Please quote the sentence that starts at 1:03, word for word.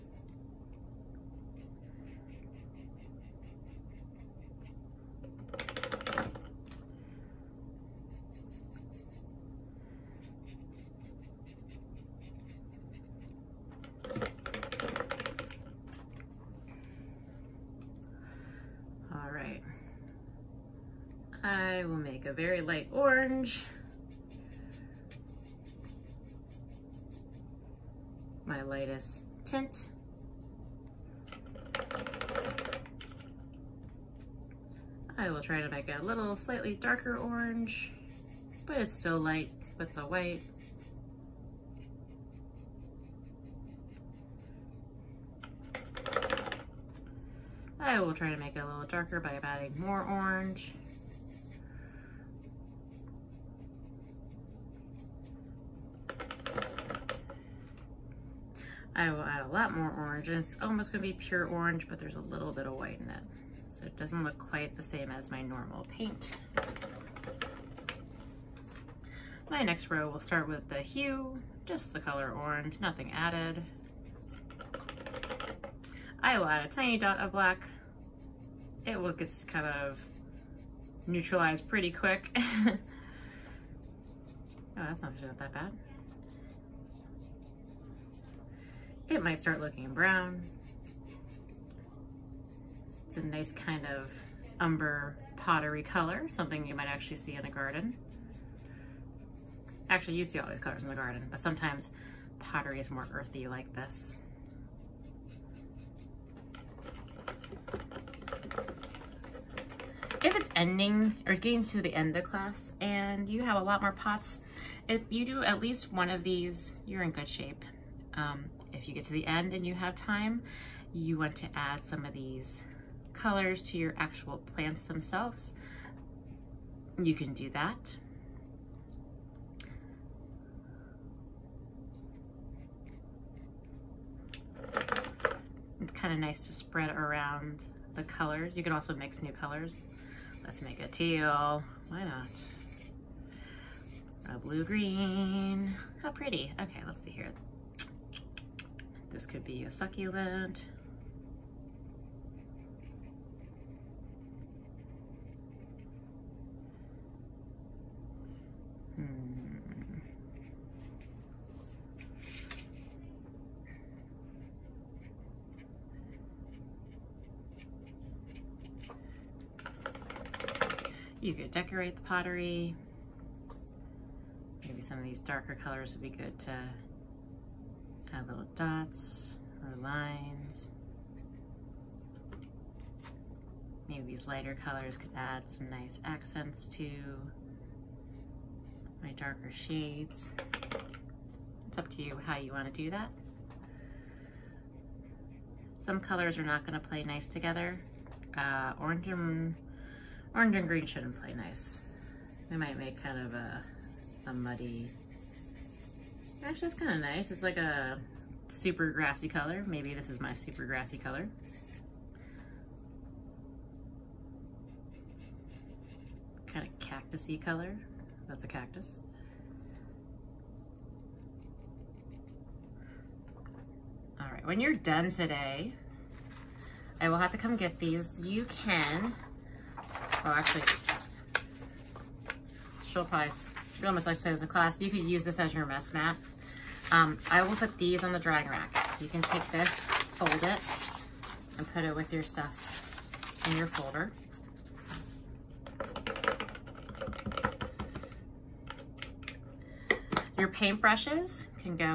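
So it doesn't look quite the same as my normal paint.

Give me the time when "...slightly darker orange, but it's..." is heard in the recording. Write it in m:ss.
0:36.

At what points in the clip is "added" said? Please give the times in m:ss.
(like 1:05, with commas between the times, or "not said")
1:13.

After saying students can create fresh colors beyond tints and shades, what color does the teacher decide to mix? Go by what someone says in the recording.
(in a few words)
teal.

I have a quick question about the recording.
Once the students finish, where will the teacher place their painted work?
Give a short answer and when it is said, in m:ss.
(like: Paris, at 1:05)
the drying rack, at 3:58.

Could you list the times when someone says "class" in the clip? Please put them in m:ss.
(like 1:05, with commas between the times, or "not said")
1:52, 3:54.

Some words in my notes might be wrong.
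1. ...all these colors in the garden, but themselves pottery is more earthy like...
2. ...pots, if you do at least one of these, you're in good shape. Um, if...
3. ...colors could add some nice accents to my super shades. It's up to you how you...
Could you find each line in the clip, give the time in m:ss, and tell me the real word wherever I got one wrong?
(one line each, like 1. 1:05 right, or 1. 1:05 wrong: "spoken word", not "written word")
1. 1:40 wrong: "sometimes", not "themselves"
2. 1:53 right
3. 3:04 wrong: "darker", not "super".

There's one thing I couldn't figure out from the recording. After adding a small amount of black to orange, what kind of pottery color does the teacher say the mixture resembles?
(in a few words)
umber.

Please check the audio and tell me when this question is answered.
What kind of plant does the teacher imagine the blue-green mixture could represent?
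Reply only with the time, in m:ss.
2:29.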